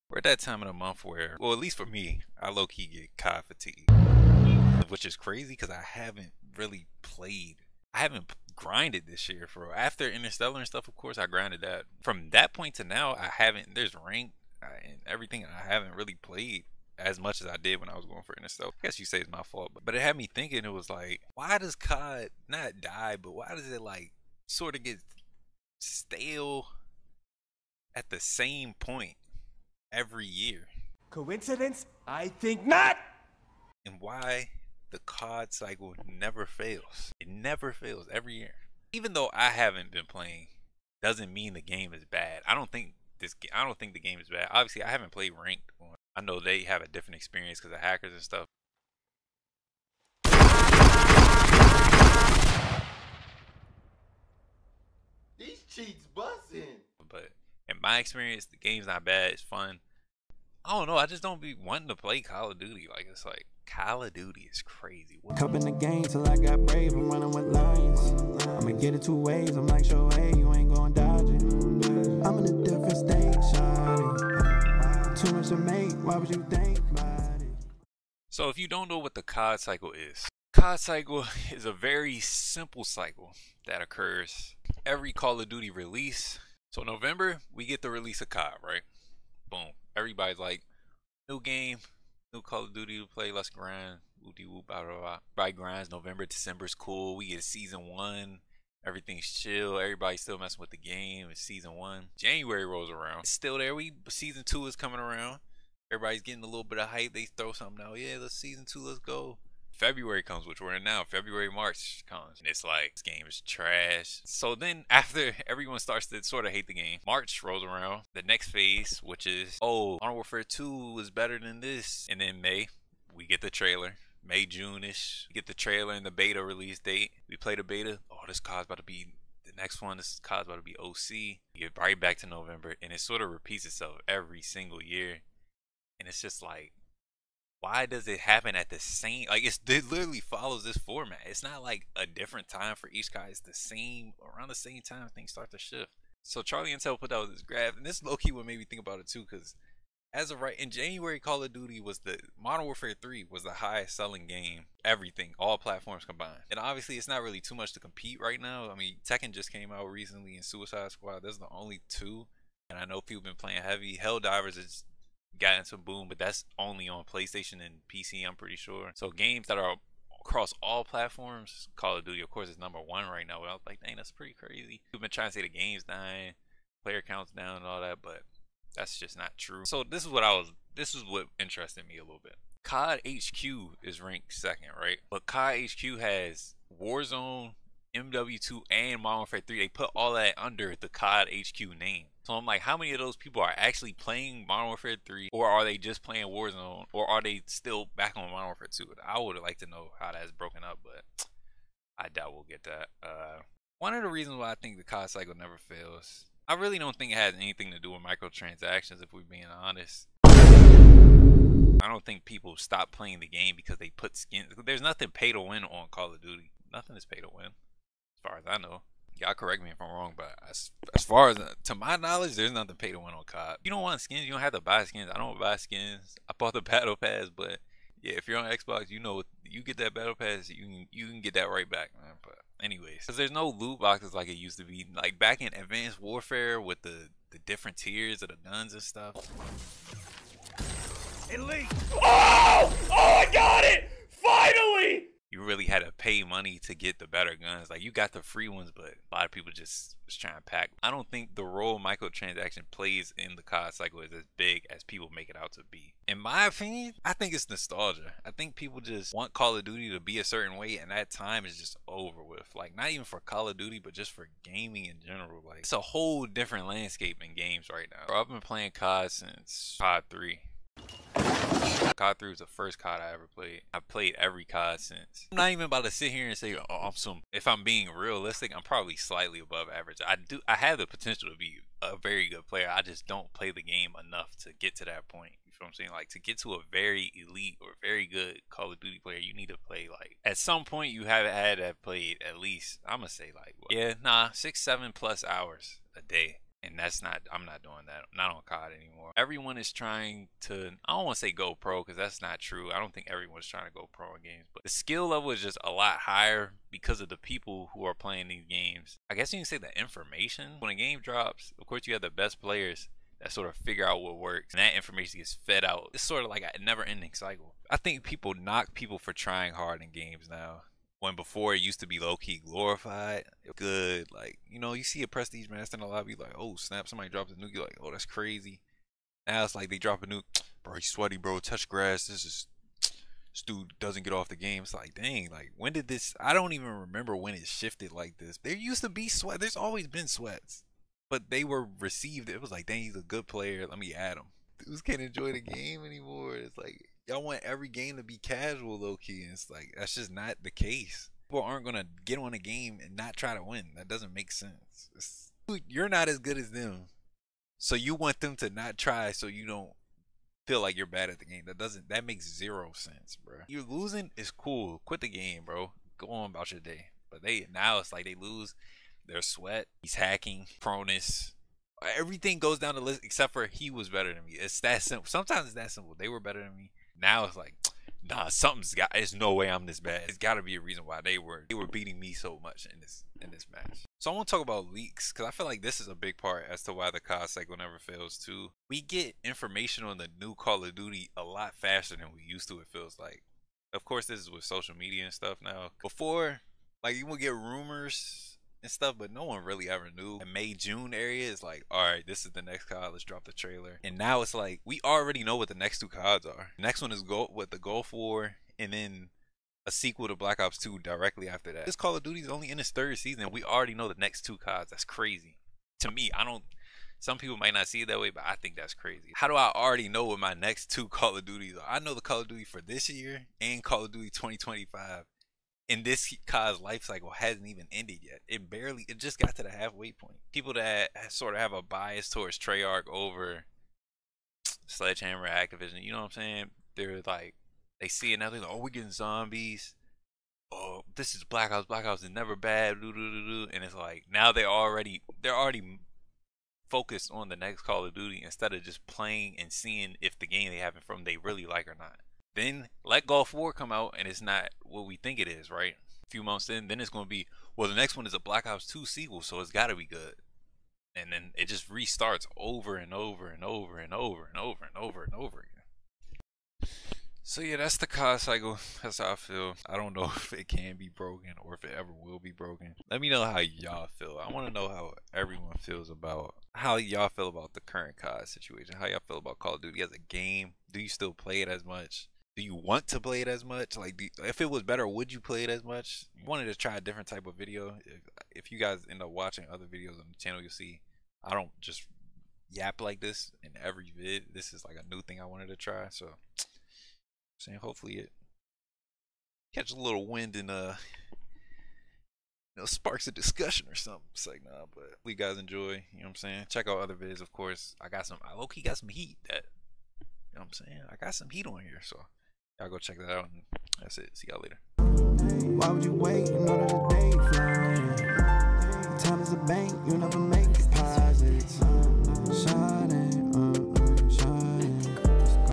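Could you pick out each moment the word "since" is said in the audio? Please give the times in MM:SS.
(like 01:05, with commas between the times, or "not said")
04:29, 04:34.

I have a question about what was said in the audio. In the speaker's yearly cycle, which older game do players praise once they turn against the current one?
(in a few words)
Modern Warfare 2.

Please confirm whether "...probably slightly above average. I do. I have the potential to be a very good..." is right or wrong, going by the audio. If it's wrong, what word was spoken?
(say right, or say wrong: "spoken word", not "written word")
right.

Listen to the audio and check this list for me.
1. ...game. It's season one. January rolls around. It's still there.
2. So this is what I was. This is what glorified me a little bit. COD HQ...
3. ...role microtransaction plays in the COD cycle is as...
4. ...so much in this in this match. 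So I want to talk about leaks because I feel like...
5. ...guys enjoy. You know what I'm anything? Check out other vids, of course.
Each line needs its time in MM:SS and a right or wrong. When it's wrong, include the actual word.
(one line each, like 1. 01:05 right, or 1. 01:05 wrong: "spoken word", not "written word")
1. 01:40 right
2. 02:59 wrong: "interested", not "glorified"
3. 04:11 right
4. 06:22 right
5. 08:25 wrong: "saying", not "anything".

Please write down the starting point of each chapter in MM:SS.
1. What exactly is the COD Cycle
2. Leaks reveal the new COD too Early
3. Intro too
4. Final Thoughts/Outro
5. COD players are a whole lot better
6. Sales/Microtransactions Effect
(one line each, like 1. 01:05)
1. 01:17
2. 06:23
3. 01:05
4. 08:02
5. 04:15
6. 02:26.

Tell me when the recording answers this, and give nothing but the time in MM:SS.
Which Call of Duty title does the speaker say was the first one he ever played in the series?
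04:31.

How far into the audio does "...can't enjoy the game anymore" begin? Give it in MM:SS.
05:44.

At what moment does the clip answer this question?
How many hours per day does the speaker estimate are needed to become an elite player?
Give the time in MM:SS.
04:54.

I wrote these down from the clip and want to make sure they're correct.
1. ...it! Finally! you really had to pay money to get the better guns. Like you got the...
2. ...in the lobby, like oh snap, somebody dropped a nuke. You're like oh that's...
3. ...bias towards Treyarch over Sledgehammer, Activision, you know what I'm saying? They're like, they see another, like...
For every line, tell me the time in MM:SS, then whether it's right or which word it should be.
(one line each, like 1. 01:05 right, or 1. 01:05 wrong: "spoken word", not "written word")
1. 04:03 right
2. 05:25 right
3. 07:11 right.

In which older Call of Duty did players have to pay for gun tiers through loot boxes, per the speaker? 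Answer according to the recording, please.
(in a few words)
Advanced Warfare.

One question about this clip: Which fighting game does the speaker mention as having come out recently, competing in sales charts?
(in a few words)
Tekken.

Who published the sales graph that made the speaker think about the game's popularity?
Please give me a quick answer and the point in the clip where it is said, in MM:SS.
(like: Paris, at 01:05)
Charlie Intel, at 02:26.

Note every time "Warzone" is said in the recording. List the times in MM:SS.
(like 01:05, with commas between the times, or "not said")
03:06, 03:16.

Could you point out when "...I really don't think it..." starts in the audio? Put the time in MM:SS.
03:26.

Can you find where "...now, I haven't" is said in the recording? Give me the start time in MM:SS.
00:12.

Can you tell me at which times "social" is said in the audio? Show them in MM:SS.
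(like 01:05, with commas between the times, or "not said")
06:34.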